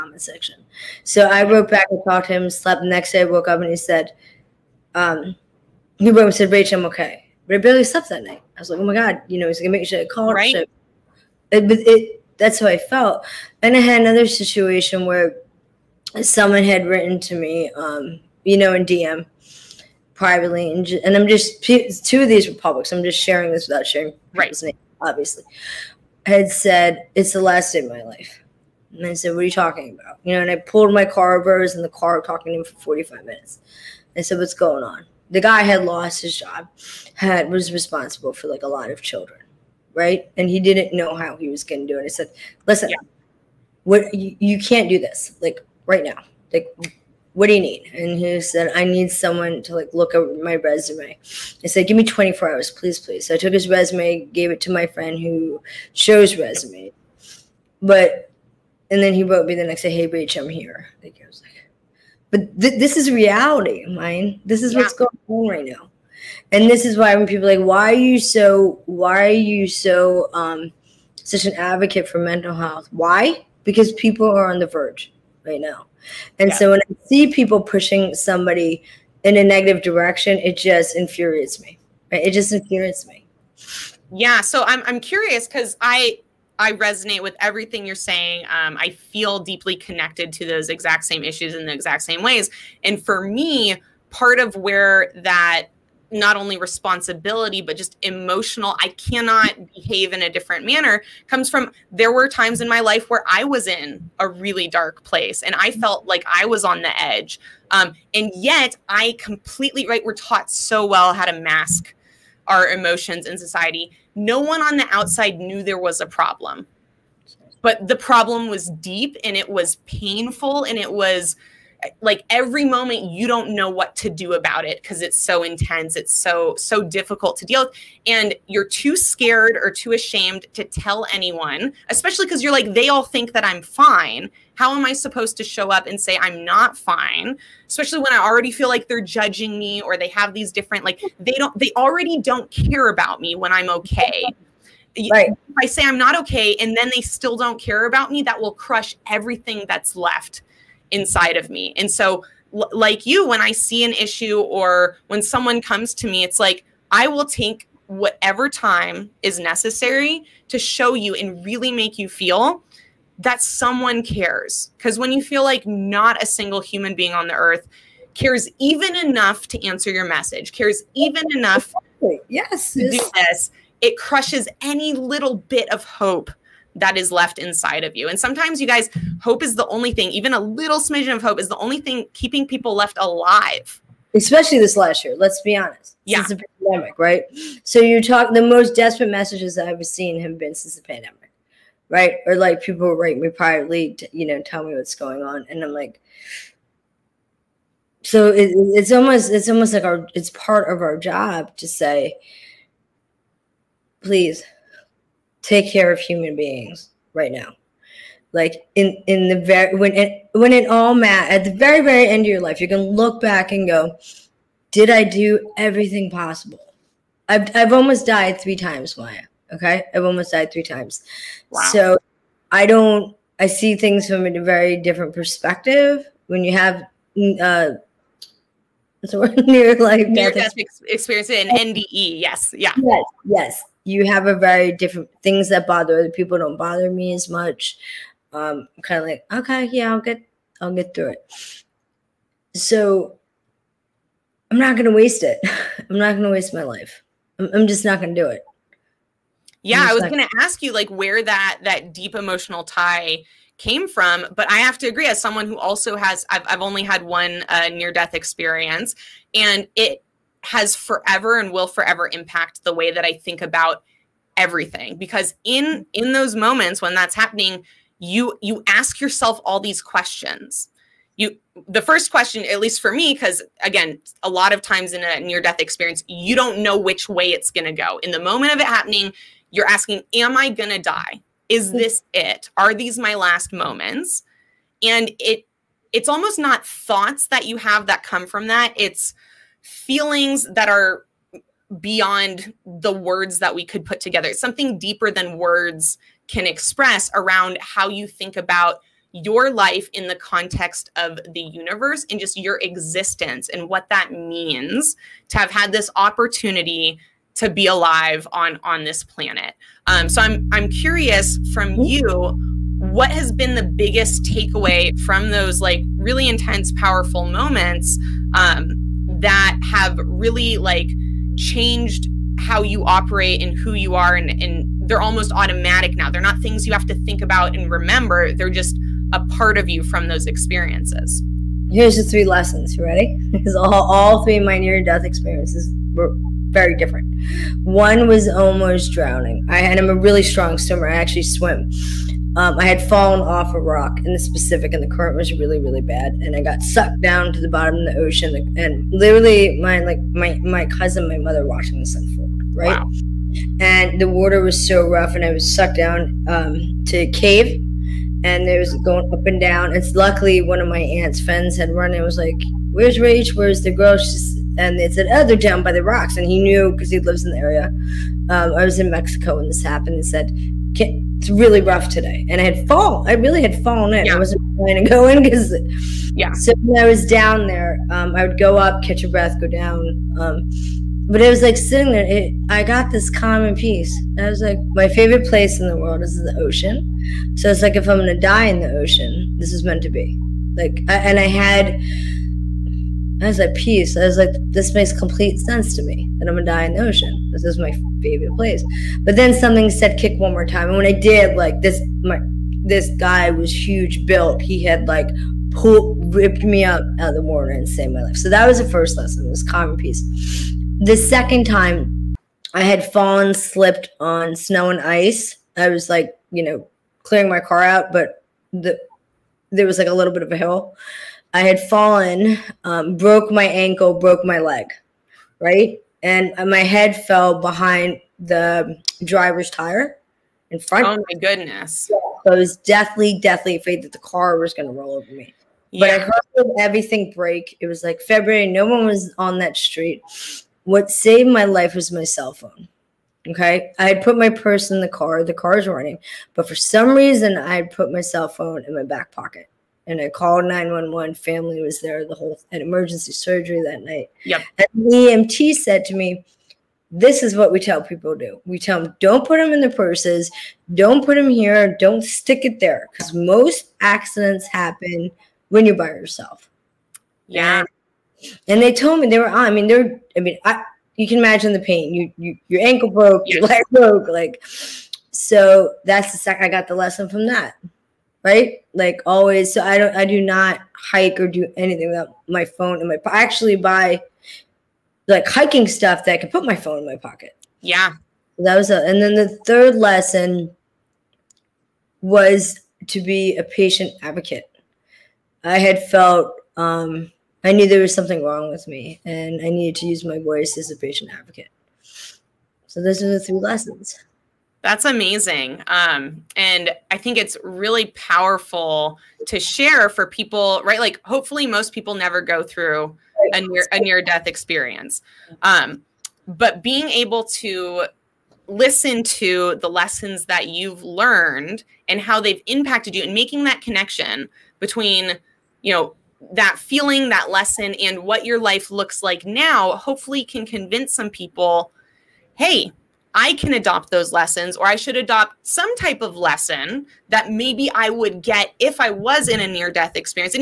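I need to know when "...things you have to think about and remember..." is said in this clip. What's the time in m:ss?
5:26.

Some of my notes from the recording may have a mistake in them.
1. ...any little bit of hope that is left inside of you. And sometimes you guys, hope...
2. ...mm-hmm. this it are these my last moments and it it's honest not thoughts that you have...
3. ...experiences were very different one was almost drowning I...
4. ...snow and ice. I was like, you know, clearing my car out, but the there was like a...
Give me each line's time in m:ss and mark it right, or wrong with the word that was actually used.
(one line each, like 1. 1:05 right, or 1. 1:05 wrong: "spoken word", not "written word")
1. 2:54 right
2. 4:41 wrong: "almost", not "honest"
3. 5:35 right
4. 6:54 right.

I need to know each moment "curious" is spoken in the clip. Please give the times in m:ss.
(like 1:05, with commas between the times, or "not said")
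1:24, 5:10.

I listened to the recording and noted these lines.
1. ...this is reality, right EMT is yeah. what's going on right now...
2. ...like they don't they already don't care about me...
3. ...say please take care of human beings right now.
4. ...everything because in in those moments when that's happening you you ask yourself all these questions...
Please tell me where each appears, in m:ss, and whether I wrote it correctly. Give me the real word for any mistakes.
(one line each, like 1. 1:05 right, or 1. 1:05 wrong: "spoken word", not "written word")
1. 1:02 wrong: "This", not "EMT"
2. 2:20 right
3. 3:21 right
4. 4:24 right.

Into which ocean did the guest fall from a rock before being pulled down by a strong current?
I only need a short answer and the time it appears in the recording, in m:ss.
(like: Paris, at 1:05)
Pacific, at 5:44.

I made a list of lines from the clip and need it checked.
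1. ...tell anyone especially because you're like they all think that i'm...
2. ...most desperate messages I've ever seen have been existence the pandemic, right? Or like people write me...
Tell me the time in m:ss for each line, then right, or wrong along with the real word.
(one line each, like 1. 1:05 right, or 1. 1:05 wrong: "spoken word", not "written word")
1. 2:10 right
2. 3:08 wrong: "since", not "existence".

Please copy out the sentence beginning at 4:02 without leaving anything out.
So I'm not gonna waste it.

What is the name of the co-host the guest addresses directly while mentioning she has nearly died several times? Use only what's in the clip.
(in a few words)
Maya.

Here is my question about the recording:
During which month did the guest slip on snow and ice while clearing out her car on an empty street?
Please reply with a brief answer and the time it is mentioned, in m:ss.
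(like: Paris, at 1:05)
February, at 7:18.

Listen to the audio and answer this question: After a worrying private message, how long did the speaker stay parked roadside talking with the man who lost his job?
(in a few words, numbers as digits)
45 minutes.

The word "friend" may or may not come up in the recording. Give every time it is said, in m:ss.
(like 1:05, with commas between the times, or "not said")
0:54, 6:01.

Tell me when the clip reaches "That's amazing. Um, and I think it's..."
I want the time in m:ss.
8:24.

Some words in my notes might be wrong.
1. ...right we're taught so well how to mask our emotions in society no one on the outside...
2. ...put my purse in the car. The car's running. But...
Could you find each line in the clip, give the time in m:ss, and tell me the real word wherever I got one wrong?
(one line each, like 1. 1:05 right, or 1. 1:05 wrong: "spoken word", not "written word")
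1. 1:49 right
2. 7:24 right.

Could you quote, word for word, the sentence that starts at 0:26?
I had said, it's the last day of my life.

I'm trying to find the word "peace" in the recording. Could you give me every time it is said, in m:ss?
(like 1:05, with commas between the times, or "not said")
6:23, 6:33, 6:49.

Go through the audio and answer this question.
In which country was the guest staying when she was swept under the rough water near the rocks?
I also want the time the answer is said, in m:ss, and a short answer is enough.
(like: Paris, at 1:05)
Mexico, at 6:08.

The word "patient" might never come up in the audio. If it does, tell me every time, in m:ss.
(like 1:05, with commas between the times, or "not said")
8:13, 8:20.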